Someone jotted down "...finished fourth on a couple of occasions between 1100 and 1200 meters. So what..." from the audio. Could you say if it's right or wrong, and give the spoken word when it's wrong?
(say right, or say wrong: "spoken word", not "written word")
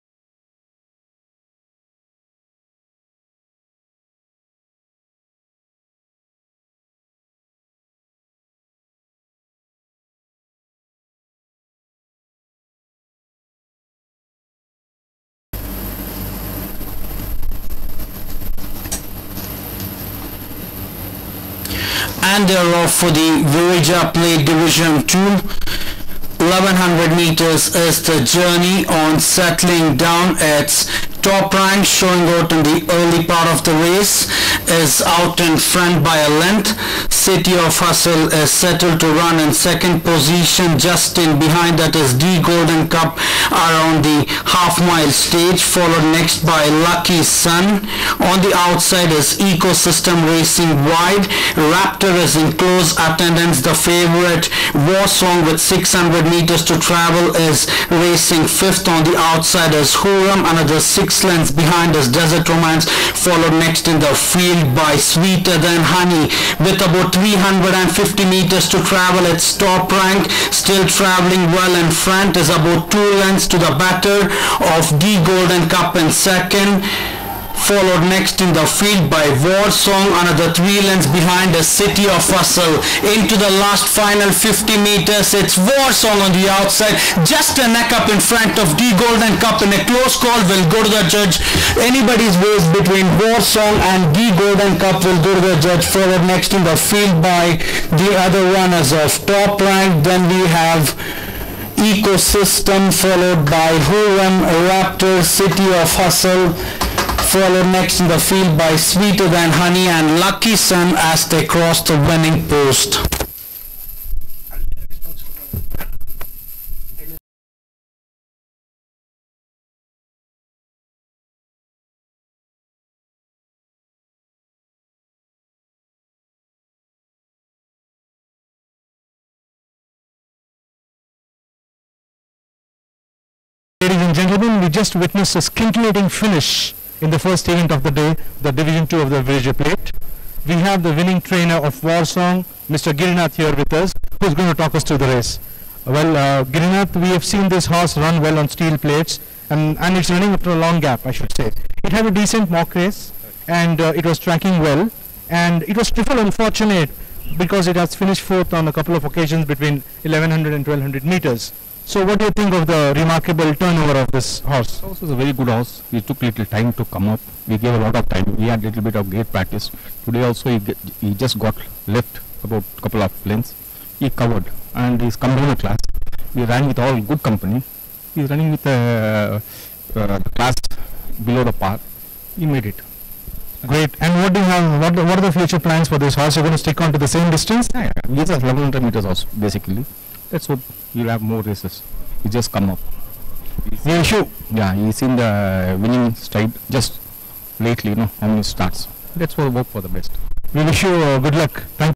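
right.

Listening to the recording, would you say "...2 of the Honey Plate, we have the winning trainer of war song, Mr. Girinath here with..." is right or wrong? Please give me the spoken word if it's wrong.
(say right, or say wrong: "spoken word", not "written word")
wrong: "Virija", not "Honey".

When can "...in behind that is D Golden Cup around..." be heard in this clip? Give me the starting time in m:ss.
0:41.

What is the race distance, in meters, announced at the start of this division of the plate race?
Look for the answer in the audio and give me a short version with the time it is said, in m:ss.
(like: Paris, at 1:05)
1100 meters, at 0:26.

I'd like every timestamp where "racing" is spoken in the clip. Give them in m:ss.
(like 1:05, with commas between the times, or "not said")
0:50, 0:58.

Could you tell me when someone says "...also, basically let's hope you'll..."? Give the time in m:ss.
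3:09.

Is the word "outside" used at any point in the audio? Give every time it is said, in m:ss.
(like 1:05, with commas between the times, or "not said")
0:48, 0:59, 1:26.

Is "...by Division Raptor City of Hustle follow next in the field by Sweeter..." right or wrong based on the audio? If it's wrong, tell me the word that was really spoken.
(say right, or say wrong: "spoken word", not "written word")
wrong: "Huram", not "Division".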